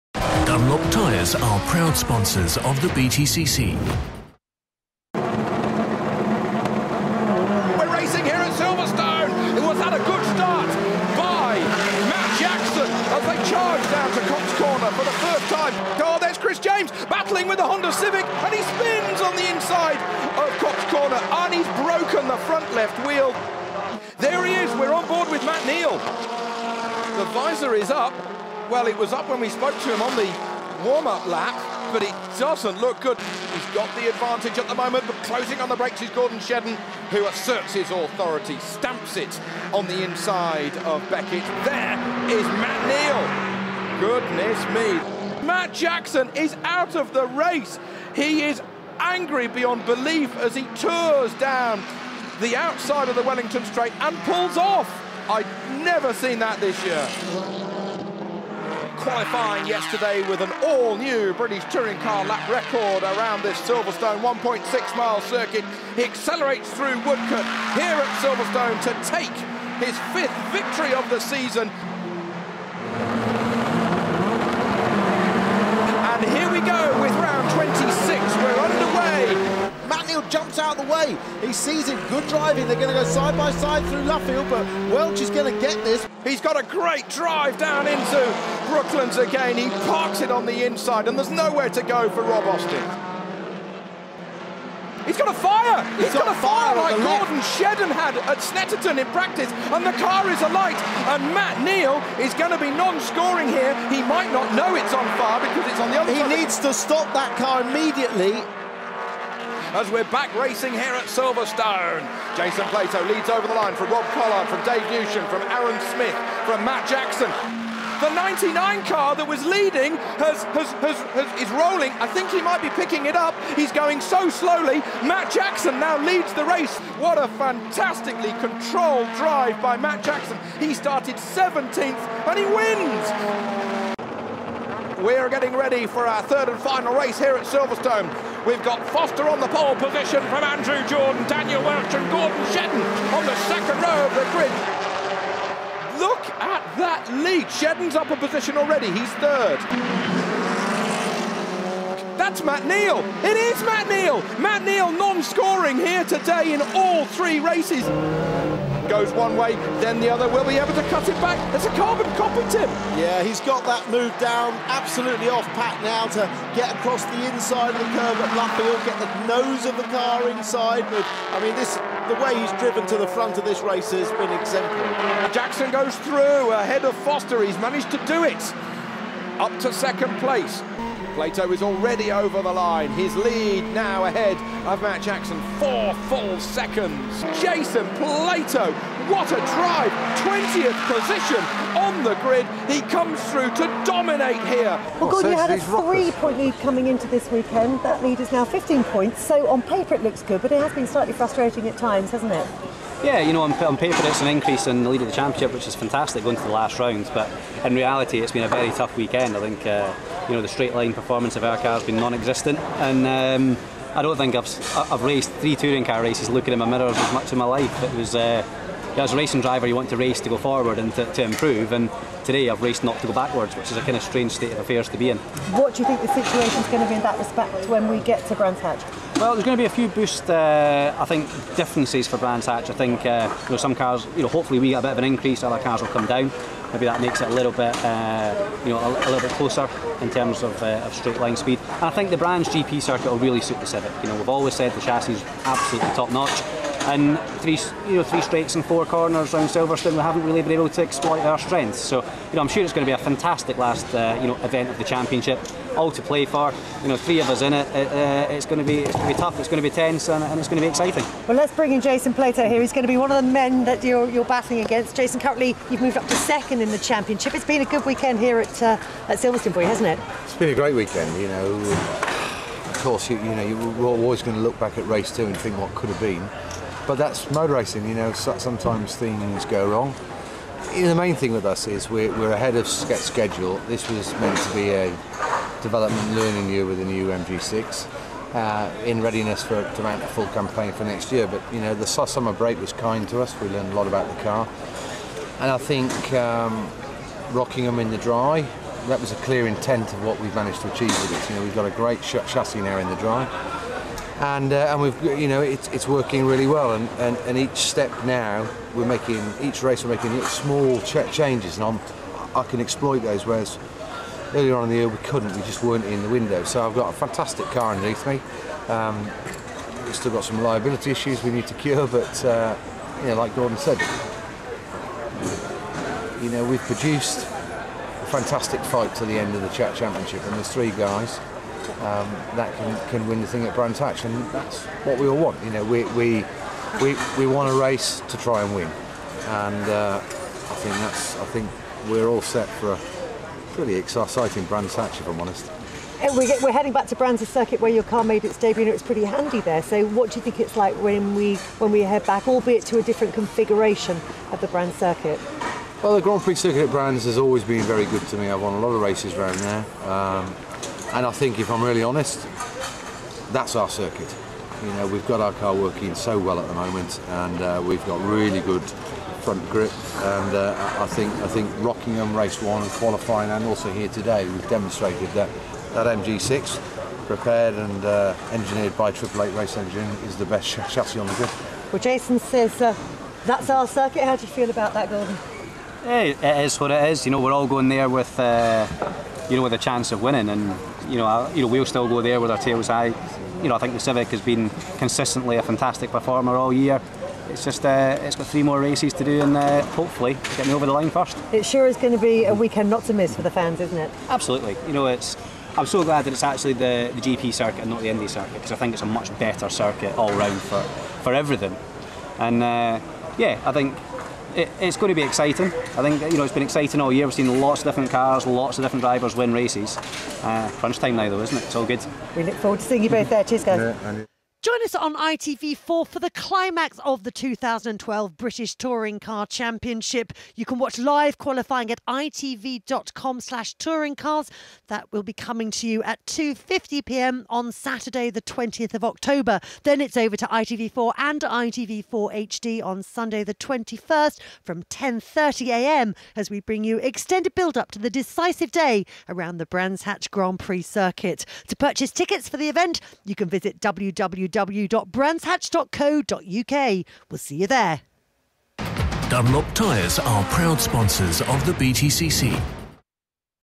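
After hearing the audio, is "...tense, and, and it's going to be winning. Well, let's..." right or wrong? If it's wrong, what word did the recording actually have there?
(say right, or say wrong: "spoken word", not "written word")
wrong: "exciting", not "winning".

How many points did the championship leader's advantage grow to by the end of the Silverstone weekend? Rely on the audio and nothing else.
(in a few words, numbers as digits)
15.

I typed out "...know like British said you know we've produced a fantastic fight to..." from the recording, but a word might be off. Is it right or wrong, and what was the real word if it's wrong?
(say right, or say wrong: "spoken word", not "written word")
wrong: "Gordon", not "British".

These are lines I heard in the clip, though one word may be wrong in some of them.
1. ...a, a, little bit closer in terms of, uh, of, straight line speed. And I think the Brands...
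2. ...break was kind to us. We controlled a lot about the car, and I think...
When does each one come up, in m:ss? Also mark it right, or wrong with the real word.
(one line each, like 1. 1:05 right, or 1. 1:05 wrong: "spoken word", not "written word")
1. 3:58 right
2. 4:52 wrong: "learned", not "controlled".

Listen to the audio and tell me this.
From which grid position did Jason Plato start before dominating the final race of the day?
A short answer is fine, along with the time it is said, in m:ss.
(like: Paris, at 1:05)
20th, at 3:10.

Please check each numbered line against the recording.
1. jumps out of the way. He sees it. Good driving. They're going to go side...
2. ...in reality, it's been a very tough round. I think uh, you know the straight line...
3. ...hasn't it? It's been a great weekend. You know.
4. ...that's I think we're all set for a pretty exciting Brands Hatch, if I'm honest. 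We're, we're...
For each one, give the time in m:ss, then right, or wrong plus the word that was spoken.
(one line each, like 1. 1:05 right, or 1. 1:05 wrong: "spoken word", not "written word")
1. 1:20 right
2. 3:27 wrong: "weekend", not "round"
3. 4:29 right
4. 5:40 right.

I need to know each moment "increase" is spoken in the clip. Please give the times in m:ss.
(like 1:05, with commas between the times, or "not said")
3:24, 3:55.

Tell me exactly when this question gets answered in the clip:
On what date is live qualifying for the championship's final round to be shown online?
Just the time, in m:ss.
7:17.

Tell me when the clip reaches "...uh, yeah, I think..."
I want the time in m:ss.
6:52.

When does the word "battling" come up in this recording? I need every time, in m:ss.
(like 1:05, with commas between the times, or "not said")
0:17, 4:24.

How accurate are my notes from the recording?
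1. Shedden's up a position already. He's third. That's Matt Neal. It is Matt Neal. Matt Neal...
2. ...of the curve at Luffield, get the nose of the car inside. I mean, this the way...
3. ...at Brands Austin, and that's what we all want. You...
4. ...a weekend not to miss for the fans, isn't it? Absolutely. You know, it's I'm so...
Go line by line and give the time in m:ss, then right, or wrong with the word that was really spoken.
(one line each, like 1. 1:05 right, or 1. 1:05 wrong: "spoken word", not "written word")
1. 2:27 right
2. 2:47 right
3. 5:33 wrong: "Hatch", not "Austin"
4. 6:42 right.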